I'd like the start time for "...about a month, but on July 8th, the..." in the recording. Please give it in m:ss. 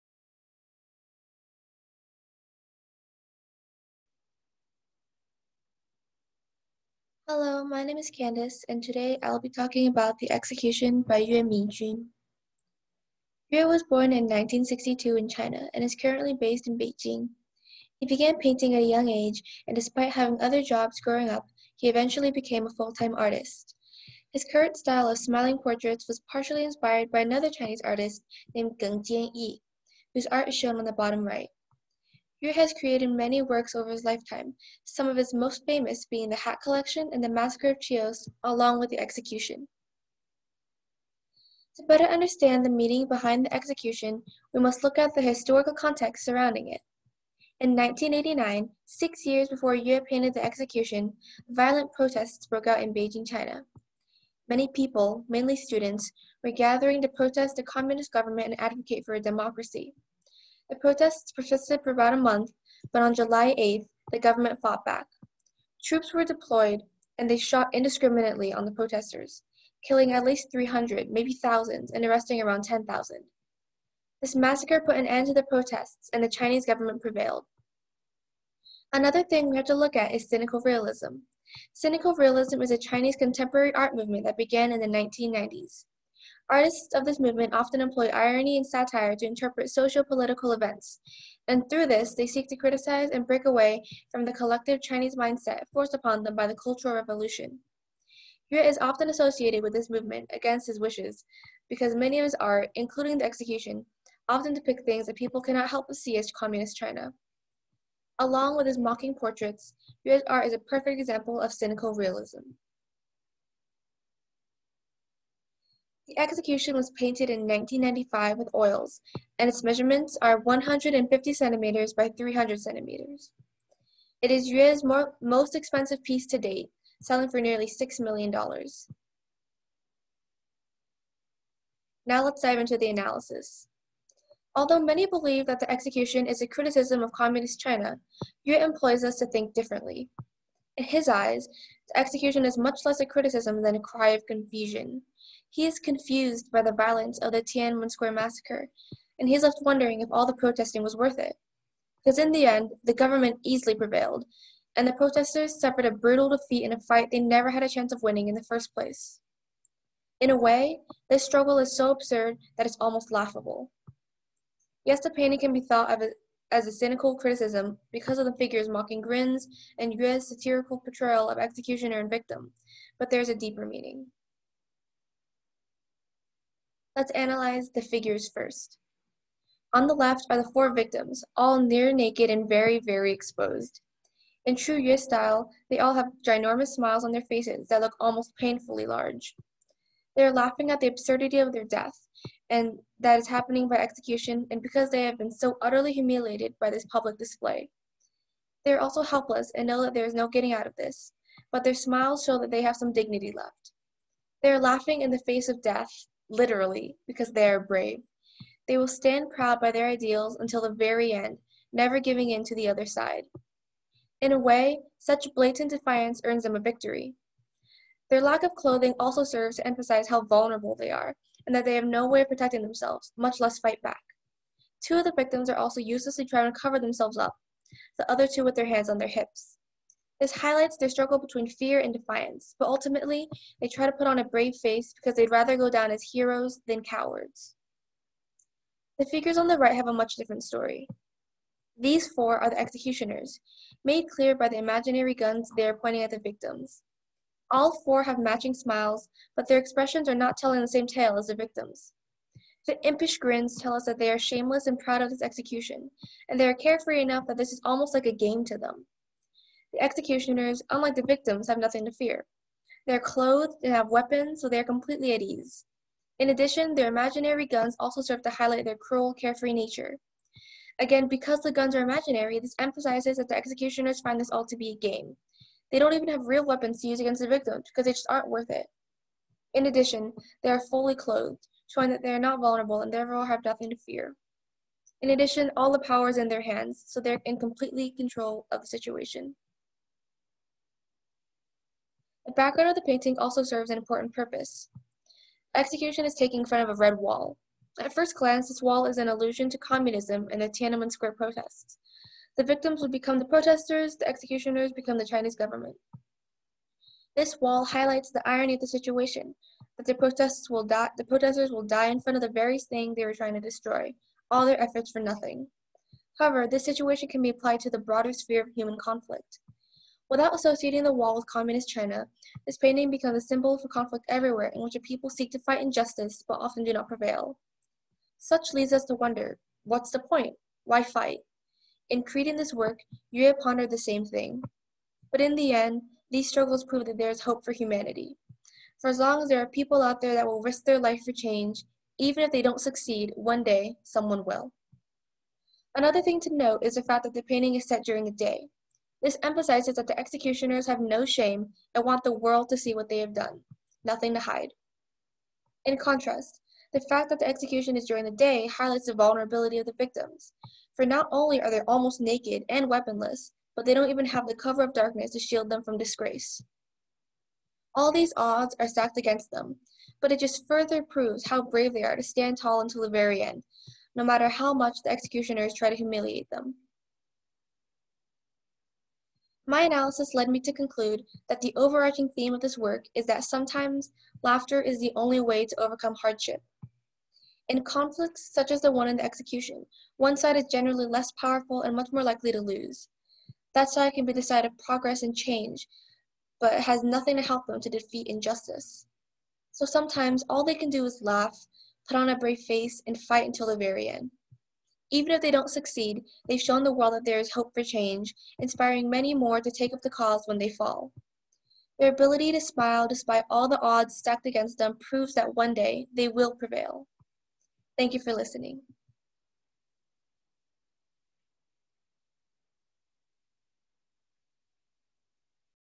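1:01.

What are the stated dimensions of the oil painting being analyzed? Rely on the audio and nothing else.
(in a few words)
150 cm by 300 cm.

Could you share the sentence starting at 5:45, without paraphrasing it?
Another thing to note is the fact that the painting is set during the day.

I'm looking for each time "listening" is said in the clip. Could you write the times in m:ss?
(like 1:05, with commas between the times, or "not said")
6:58.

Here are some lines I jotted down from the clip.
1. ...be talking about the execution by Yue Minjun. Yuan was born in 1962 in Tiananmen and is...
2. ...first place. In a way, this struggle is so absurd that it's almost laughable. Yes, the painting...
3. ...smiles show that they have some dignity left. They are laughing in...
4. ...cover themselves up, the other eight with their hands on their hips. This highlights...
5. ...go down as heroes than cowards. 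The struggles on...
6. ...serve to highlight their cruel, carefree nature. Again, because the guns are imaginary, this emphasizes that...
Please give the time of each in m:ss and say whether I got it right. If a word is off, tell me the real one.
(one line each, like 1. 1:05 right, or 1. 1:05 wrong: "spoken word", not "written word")
1. 0:09 wrong: "China", not "Tiananmen"
2. 2:38 right
3. 3:21 right
4. 3:46 wrong: "two", not "eight"
5. 3:55 wrong: "figures", not "struggles"
6. 4:28 right.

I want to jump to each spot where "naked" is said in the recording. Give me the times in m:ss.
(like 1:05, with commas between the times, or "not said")
3:01, 6:01.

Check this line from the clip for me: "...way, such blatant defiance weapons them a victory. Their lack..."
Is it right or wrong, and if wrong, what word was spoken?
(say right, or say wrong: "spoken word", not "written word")
wrong: "earns", not "weapons".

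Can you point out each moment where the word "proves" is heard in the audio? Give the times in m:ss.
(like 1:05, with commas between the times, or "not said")
5:36, 6:10, 6:54.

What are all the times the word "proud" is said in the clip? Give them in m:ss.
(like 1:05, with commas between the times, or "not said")
3:29, 4:14.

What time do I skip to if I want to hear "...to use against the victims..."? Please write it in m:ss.
4:36.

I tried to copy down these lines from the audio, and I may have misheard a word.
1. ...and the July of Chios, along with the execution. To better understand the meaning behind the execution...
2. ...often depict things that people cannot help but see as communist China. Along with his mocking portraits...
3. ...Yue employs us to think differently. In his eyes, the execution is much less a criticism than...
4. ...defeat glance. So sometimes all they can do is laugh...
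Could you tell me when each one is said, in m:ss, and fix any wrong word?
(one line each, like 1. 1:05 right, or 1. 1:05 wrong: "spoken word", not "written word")
1. 0:37 wrong: "Massacre", not "July"
2. 1:44 right
3. 2:18 right
4. 6:37 wrong: "injustice", not "glance".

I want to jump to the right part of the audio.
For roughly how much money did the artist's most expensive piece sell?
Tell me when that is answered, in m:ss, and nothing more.
2:07.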